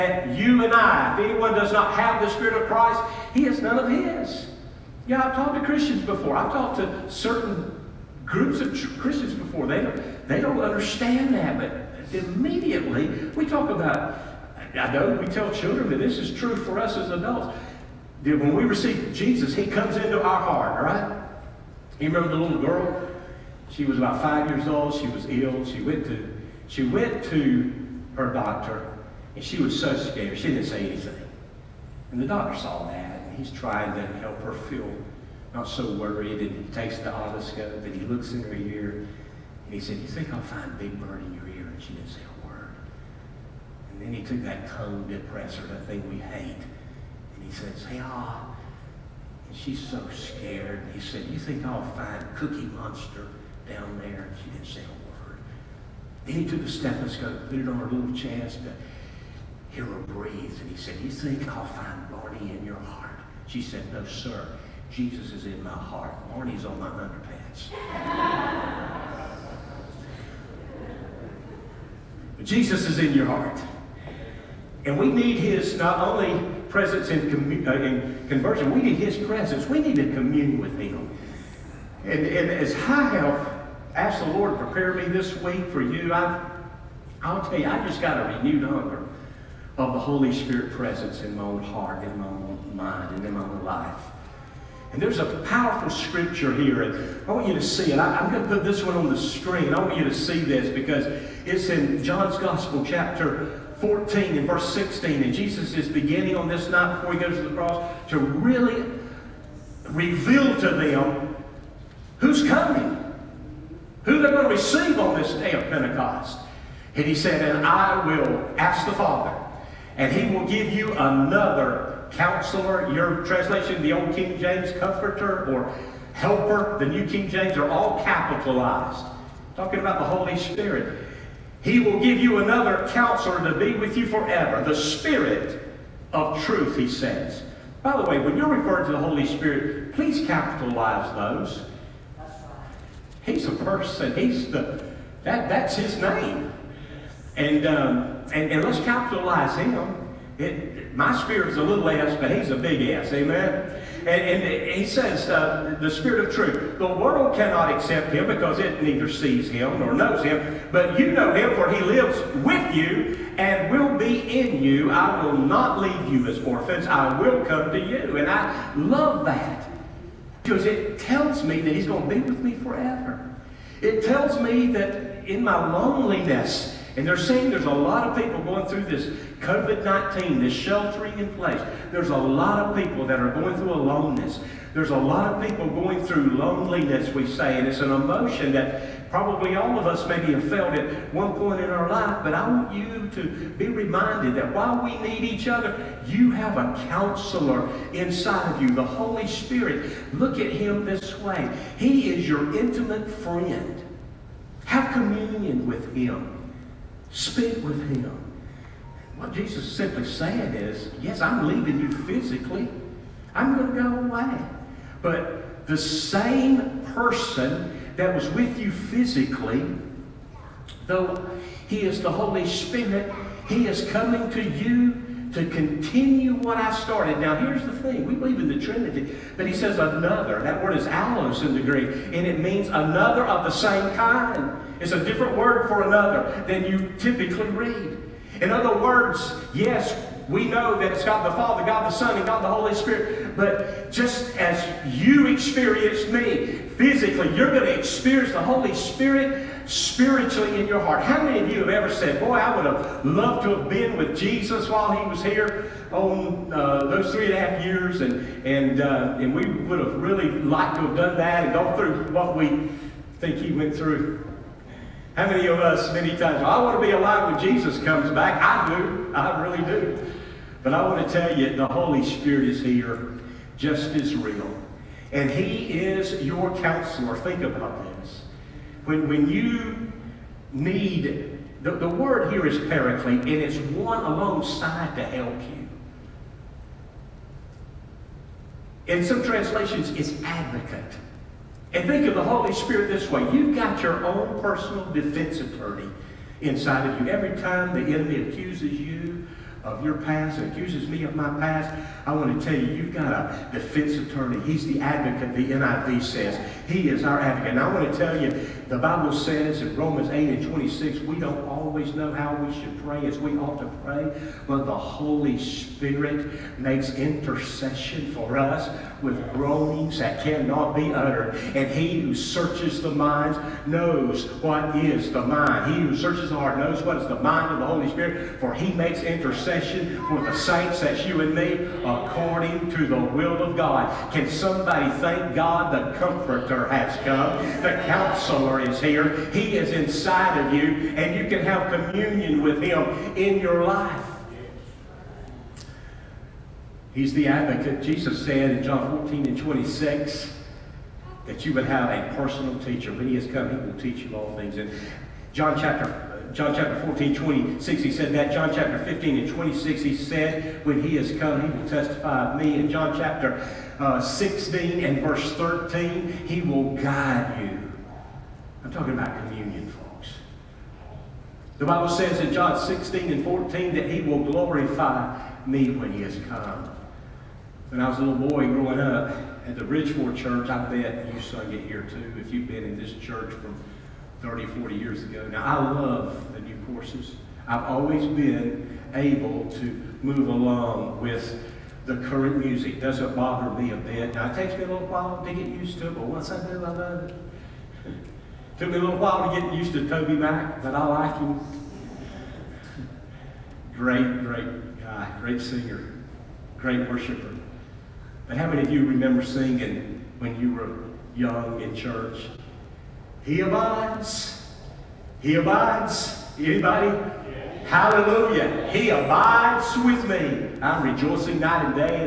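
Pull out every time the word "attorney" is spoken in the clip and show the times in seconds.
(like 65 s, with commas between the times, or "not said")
295 s, 303 s.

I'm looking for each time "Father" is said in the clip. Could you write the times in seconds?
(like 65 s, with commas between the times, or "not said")
118 s, 241 s.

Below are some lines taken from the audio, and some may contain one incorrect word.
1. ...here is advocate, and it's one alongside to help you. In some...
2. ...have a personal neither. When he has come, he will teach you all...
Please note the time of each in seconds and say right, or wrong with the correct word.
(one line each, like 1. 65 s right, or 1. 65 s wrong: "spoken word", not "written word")
1. 282 s wrong: "paraclete", not "advocate"
2. 351 s wrong: "teacher", not "neither".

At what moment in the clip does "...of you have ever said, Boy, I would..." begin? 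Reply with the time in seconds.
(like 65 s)
251 s.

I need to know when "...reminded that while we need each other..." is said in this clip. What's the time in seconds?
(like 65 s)
193 s.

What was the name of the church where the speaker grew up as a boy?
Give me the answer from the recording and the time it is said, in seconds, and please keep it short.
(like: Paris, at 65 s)
Bridgeport Church, at 379 s.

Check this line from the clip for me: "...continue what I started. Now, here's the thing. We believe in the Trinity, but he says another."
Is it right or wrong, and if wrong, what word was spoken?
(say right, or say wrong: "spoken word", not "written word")
right.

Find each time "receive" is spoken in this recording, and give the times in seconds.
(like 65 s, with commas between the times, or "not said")
18 s, 114 s.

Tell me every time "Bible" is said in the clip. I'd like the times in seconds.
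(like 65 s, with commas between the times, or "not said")
308 s, 371 s.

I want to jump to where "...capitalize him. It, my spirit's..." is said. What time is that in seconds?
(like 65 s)
148 s.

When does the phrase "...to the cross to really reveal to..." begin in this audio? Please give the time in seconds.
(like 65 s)
107 s.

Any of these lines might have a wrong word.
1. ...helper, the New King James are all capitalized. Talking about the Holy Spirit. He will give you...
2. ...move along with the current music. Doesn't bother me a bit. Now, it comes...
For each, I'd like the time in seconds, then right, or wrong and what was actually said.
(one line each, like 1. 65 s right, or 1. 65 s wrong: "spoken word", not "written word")
1. 126 s right
2. 390 s wrong: "takes", not "comes".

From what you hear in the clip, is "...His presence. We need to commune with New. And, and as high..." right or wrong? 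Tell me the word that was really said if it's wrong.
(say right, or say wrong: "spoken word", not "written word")
wrong: "Him", not "New".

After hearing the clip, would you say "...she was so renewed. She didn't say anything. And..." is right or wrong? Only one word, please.
wrong.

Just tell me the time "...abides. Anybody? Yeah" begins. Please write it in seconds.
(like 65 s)
415 s.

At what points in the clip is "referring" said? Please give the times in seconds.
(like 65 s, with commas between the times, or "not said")
138 s.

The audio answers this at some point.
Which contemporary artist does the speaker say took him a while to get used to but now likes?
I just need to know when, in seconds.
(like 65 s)
399 s.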